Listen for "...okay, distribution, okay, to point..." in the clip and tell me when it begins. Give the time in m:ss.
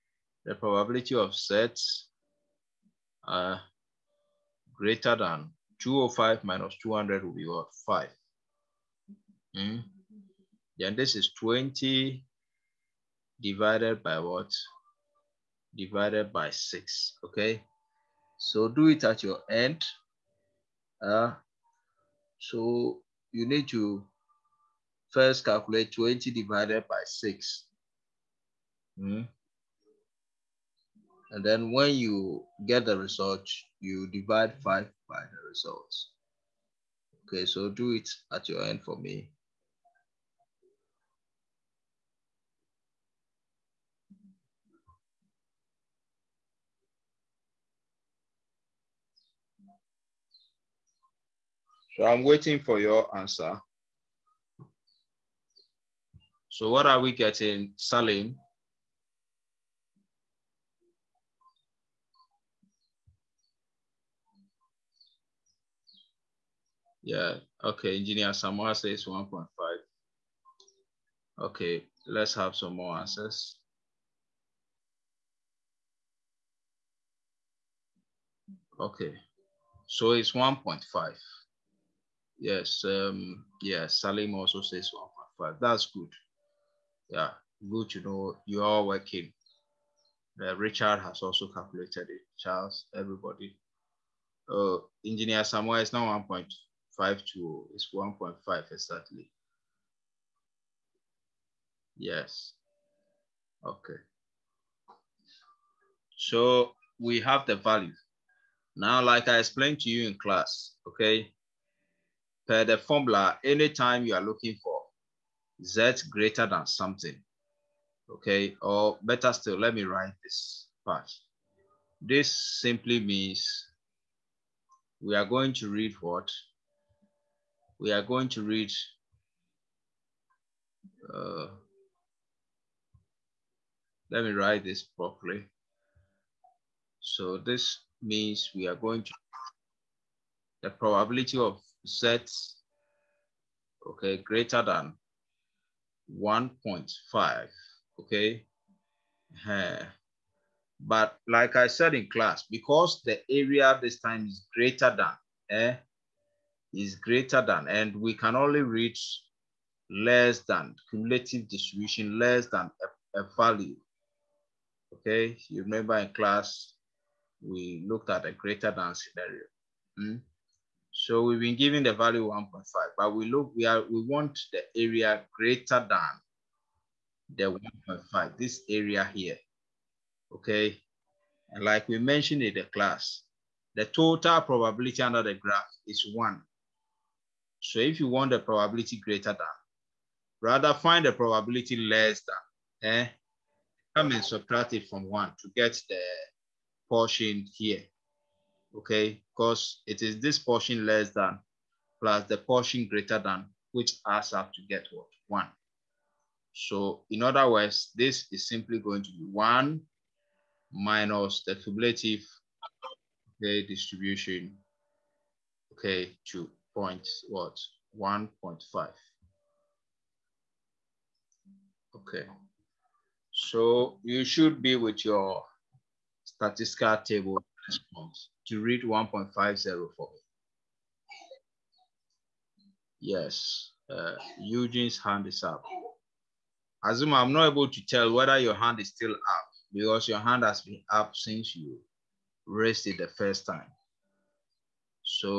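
3:33.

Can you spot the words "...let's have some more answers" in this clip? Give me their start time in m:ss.
1:12.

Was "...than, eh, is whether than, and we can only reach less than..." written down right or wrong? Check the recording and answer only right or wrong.
wrong.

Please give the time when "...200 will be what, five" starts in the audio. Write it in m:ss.
0:06.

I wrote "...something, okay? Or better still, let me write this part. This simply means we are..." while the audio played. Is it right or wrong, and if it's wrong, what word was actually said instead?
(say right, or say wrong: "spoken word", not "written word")
right.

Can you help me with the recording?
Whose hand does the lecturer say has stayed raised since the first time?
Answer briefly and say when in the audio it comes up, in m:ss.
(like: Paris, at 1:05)
Azuma, at 3:56.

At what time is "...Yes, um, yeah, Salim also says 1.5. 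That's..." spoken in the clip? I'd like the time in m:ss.
1:22.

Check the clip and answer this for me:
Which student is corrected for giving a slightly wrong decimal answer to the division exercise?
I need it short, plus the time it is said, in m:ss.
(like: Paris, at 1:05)
Engineer Samuel, at 1:35.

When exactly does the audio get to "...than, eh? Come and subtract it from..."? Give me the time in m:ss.
3:12.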